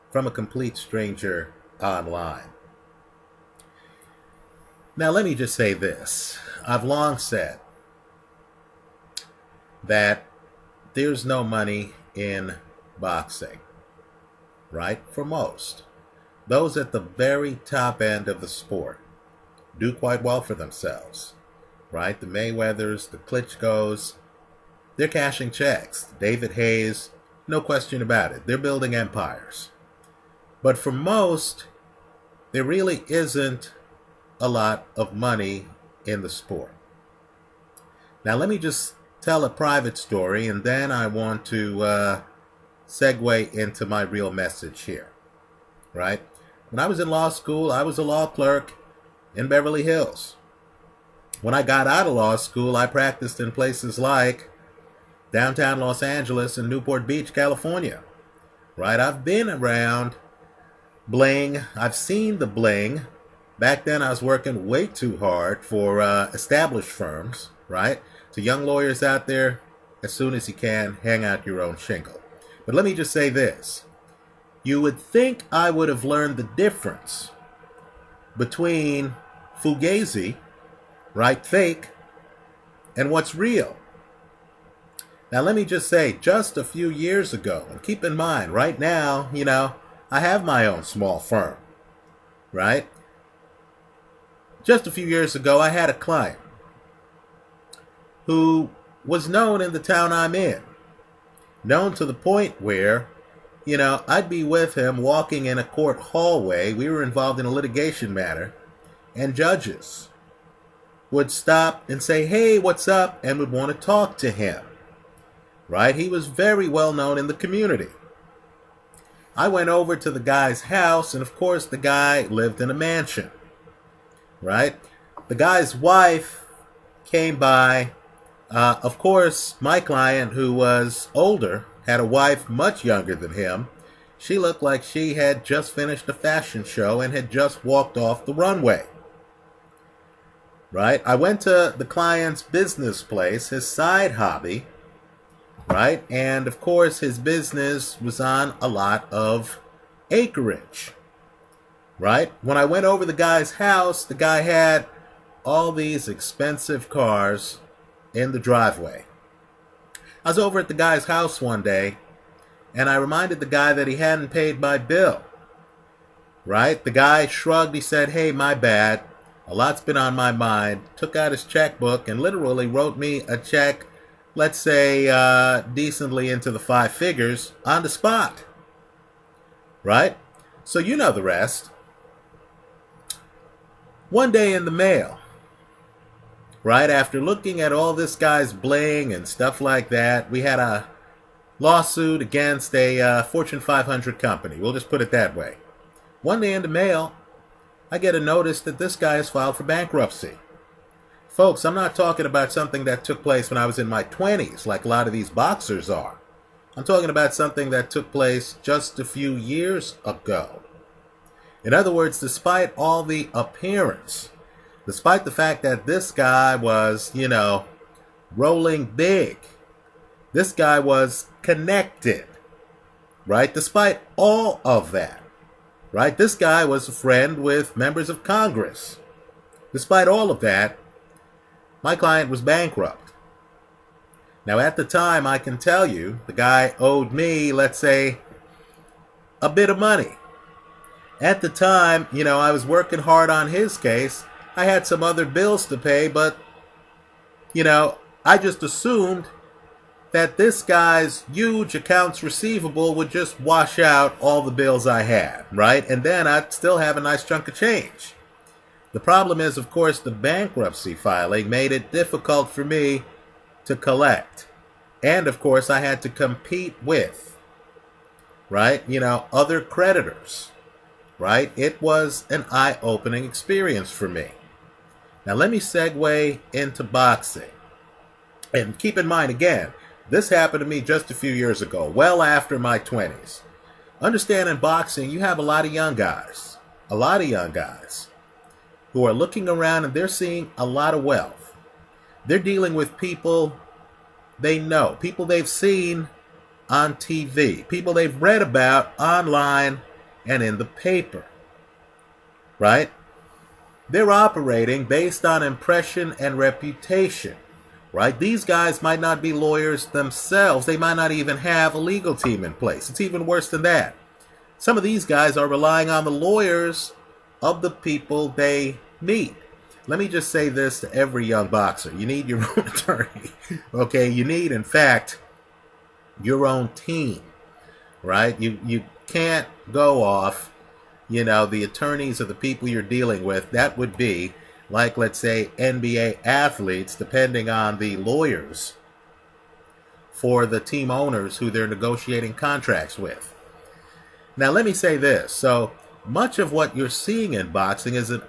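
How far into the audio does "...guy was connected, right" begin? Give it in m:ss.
3:40.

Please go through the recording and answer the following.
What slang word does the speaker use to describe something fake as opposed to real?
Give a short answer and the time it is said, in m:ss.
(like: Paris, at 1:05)
Fugazi, at 1:19.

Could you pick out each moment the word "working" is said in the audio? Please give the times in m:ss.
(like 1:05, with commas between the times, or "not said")
1:04, 4:02.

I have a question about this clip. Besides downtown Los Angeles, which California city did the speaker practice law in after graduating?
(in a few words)
Newport Beach.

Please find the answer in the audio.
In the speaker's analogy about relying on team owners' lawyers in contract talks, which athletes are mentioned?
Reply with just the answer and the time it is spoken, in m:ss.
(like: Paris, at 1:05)
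NBA athletes, at 5:35.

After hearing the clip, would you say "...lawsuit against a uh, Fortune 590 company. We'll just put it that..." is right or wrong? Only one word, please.
wrong.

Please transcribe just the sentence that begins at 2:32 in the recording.
When I went over the guy's house, the guy had all these expensive cars in the driveway.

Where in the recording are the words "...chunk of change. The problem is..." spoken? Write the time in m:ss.
4:17.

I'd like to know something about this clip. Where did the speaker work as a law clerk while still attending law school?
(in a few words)
Beverly Hills.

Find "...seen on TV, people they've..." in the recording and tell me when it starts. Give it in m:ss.
4:55.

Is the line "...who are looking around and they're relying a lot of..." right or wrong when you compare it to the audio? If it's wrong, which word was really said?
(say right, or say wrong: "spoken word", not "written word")
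wrong: "seeing", not "relying".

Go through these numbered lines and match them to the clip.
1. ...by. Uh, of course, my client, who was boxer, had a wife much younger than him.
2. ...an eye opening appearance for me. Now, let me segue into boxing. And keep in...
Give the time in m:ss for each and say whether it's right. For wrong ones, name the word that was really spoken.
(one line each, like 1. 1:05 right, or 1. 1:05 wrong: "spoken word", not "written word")
1. 2:07 wrong: "older", not "boxer"
2. 4:32 wrong: "experience", not "appearance".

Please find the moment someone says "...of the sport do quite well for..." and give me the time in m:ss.
0:18.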